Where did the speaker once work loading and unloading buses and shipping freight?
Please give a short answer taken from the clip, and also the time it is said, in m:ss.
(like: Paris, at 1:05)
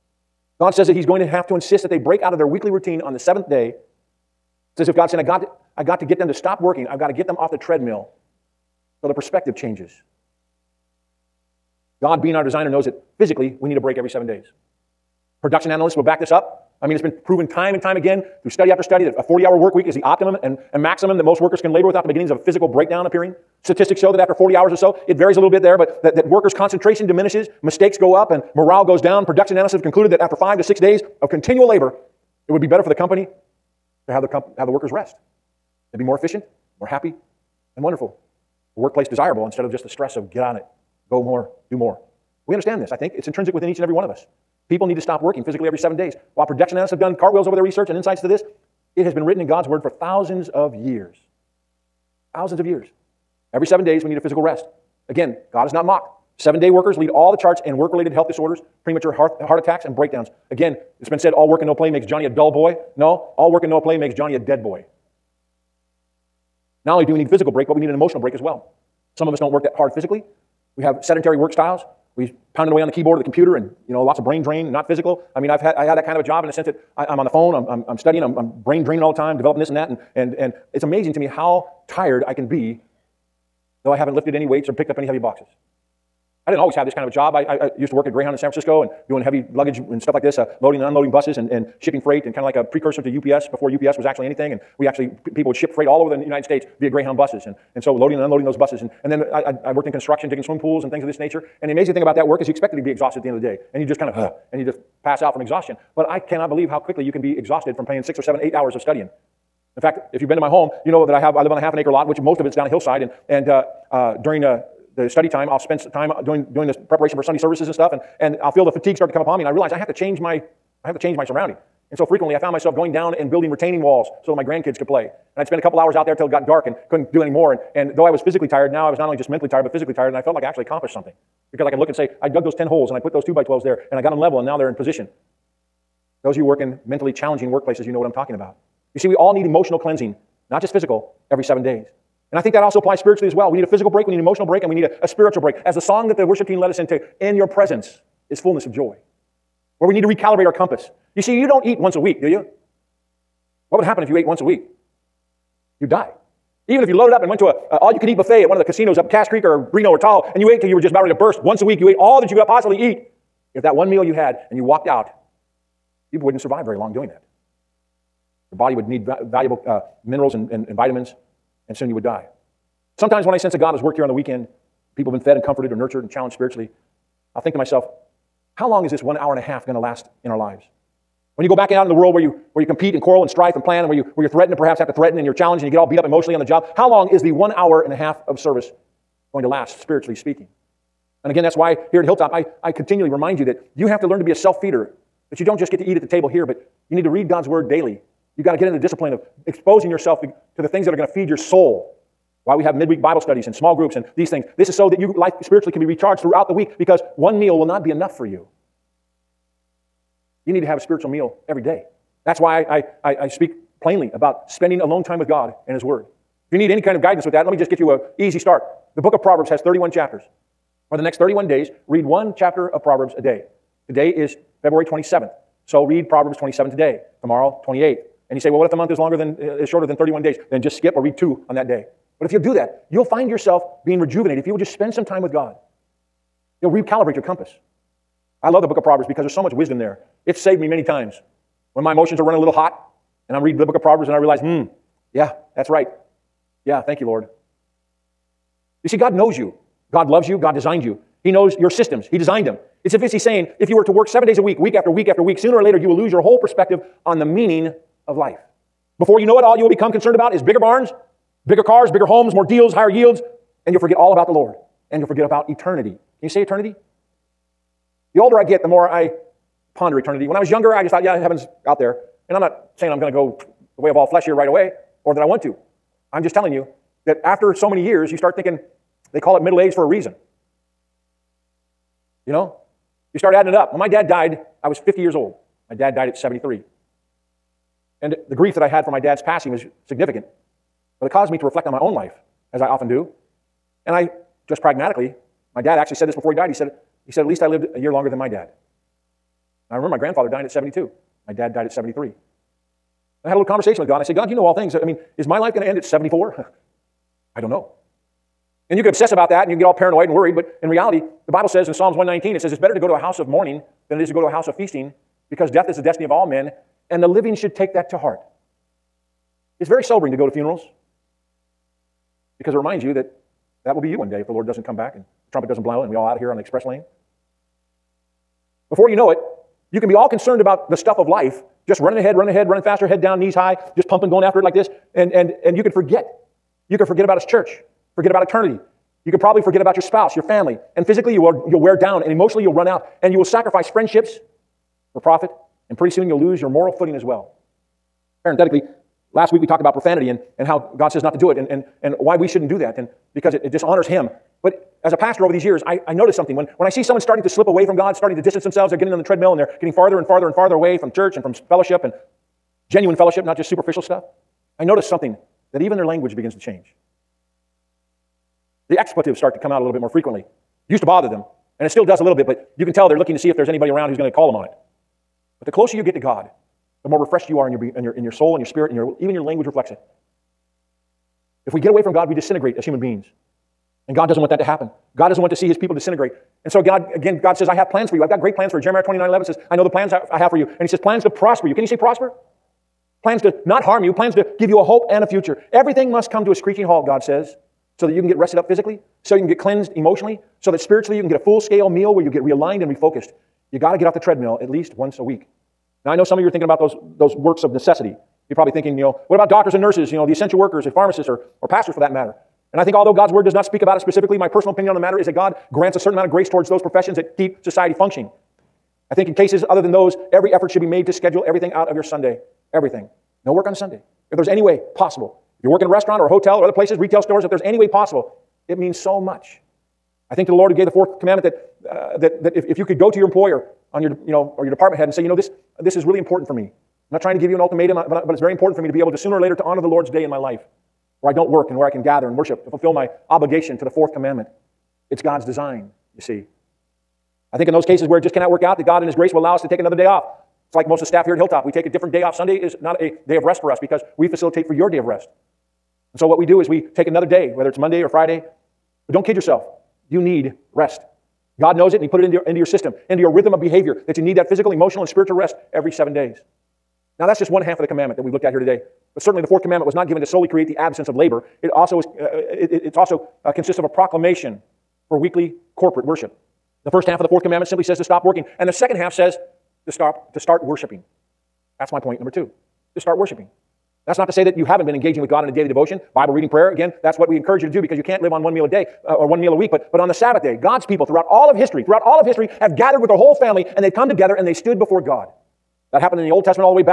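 Greyhound in San Francisco, at 1:28.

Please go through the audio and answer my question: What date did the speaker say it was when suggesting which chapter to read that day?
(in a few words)
February 27th.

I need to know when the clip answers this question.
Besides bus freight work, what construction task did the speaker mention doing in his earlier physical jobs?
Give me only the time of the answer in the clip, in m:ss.
1:40.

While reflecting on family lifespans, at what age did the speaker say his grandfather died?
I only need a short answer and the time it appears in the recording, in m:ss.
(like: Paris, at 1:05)
72, at 5:00.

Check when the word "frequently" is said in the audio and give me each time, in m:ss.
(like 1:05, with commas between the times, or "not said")
2:02, 6:09.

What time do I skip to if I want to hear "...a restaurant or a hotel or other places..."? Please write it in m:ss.
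7:05.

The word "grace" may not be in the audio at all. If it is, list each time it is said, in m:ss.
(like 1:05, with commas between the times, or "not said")
6:56, 7:28.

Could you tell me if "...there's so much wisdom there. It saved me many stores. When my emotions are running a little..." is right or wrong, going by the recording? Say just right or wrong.
wrong.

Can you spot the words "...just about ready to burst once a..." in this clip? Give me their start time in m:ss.
2:40.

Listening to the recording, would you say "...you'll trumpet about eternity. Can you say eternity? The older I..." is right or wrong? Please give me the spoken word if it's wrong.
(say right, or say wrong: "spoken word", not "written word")
wrong: "forget", not "trumpet".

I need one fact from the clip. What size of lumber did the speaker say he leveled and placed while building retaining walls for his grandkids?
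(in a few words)
2 by 12s.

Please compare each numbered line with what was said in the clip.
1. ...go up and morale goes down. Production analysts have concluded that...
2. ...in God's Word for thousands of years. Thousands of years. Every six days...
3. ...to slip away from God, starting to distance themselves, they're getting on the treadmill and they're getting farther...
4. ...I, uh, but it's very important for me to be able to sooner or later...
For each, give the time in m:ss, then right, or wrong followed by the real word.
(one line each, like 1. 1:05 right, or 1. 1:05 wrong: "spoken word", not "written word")
1. 0:27 right
2. 0:49 wrong: "seven", not "six"
3. 5:57 right
4. 7:17 right.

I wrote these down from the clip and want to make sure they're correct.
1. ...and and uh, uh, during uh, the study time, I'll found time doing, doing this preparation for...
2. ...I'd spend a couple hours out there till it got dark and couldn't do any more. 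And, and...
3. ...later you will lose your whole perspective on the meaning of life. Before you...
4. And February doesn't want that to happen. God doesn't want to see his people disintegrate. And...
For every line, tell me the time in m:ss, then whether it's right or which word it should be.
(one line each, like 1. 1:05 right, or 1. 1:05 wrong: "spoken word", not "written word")
1. 1:53 wrong: "spend", not "found"
2. 2:05 right
3. 4:15 right
4. 6:23 wrong: "God", not "February".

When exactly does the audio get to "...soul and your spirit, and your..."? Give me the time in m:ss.
6:18.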